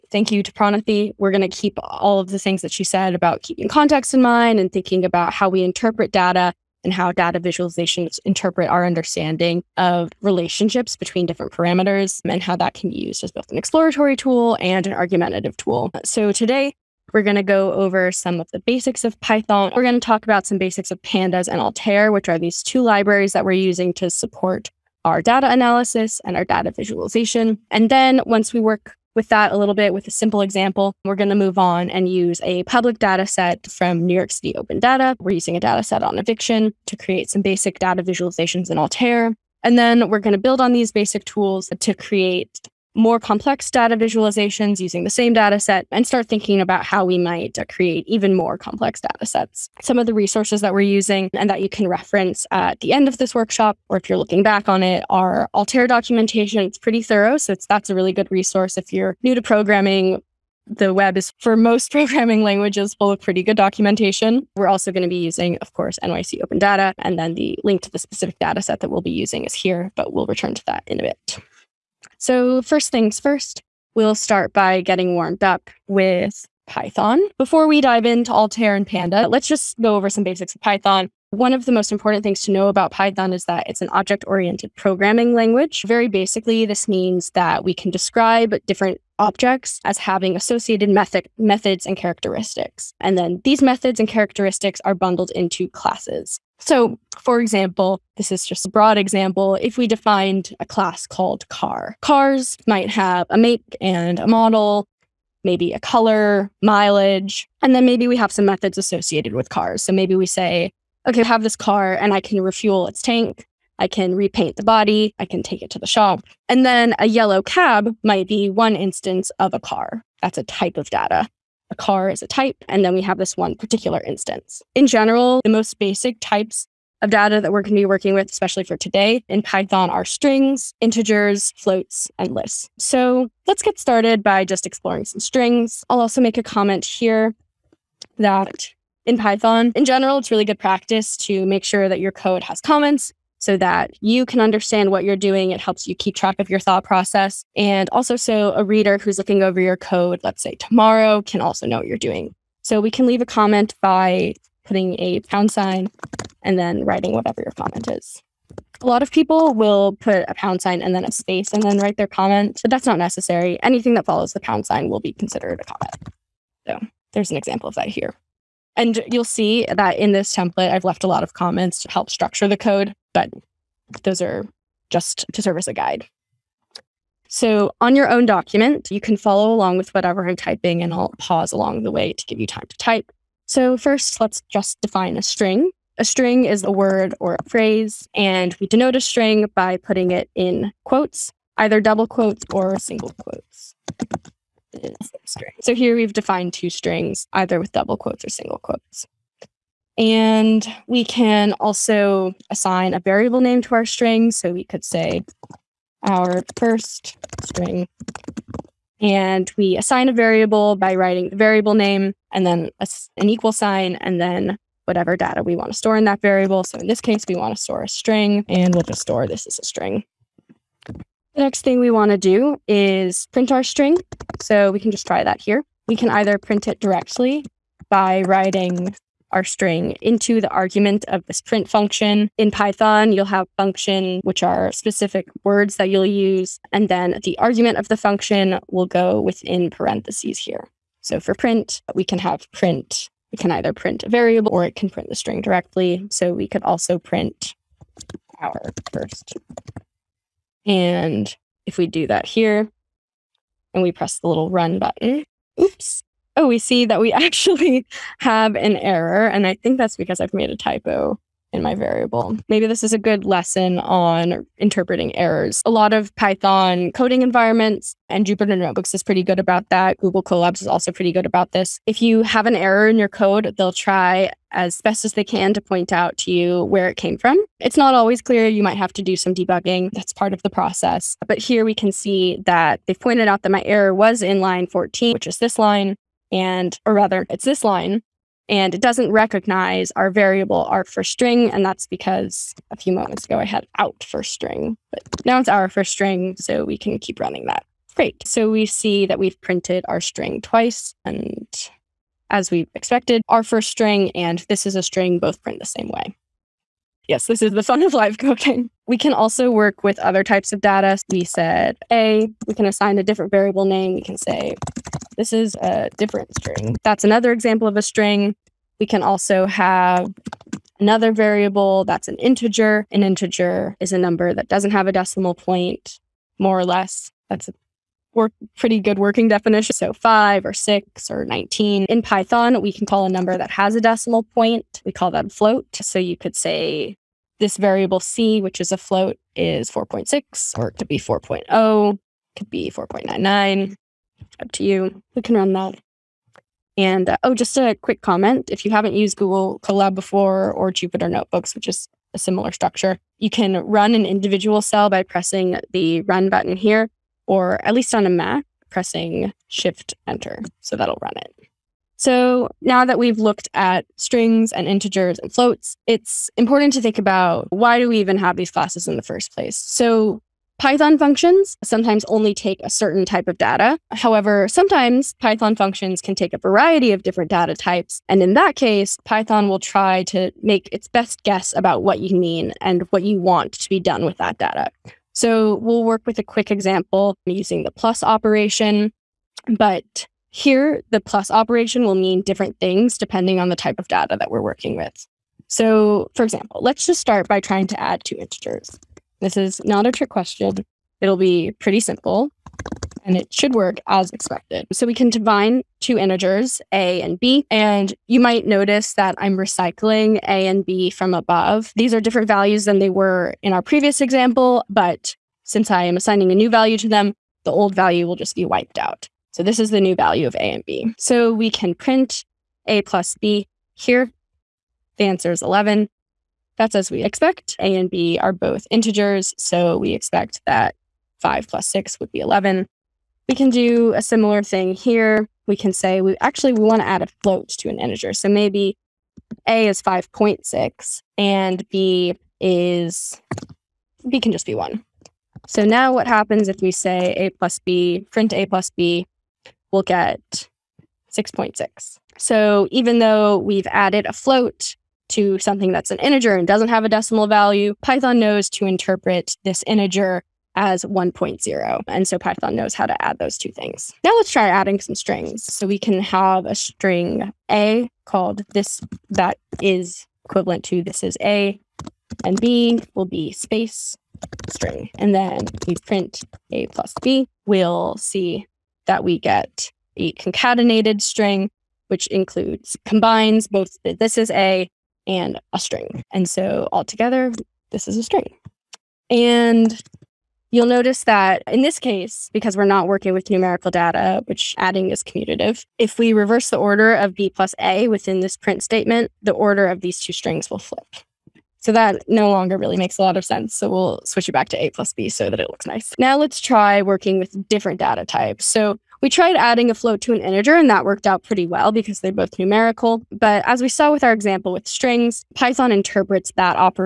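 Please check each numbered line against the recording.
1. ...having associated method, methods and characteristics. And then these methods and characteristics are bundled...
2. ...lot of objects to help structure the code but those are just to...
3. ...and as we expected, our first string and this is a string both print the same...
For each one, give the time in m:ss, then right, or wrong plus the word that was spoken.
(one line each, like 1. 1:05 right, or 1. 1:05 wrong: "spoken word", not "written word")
1. 1:29 right
2. 2:51 wrong: "comments", not "objects"
3. 5:01 right.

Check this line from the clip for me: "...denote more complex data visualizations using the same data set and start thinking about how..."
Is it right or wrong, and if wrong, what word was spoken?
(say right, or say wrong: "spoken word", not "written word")
wrong: "create", not "denote".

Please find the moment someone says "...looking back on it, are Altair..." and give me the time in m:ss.
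0:54.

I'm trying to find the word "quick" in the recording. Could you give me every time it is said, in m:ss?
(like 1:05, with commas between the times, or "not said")
5:47, 6:26.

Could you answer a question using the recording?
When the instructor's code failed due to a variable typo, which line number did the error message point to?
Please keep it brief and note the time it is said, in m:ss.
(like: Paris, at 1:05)
14, at 4:44.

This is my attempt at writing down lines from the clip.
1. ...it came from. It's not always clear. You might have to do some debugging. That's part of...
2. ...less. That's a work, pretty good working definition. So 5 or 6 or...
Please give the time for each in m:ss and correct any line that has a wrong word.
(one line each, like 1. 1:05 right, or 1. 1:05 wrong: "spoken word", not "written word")
1. 4:36 right
2. 5:26 right.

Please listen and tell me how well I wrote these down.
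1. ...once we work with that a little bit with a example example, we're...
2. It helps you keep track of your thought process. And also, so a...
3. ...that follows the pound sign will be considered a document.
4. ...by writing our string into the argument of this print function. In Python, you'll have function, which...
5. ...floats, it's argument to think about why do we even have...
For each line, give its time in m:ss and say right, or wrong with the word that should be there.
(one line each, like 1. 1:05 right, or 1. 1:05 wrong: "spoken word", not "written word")
1. 0:28 wrong: "simple", not "example"
2. 2:25 right
3. 2:43 wrong: "comment", not "document"
4. 3:47 right
5. 6:05 wrong: "important", not "argument".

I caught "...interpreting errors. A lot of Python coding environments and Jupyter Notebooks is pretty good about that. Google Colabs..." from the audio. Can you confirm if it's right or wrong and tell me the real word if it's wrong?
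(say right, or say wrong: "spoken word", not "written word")
right.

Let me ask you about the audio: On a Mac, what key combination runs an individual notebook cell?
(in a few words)
Shift Enter.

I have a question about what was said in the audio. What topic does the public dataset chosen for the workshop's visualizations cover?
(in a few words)
Eviction.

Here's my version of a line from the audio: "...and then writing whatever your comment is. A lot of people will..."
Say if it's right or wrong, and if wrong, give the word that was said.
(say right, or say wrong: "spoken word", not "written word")
right.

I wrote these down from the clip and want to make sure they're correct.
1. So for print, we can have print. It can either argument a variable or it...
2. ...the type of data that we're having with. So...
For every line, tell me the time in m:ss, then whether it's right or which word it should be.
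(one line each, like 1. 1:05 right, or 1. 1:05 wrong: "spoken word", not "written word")
1. 4:01 wrong: "print", not "argument"
2. 6:33 wrong: "working", not "having".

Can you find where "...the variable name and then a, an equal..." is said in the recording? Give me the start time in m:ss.
3:31.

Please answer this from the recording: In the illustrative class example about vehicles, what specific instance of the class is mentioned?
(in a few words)
Yellow cab.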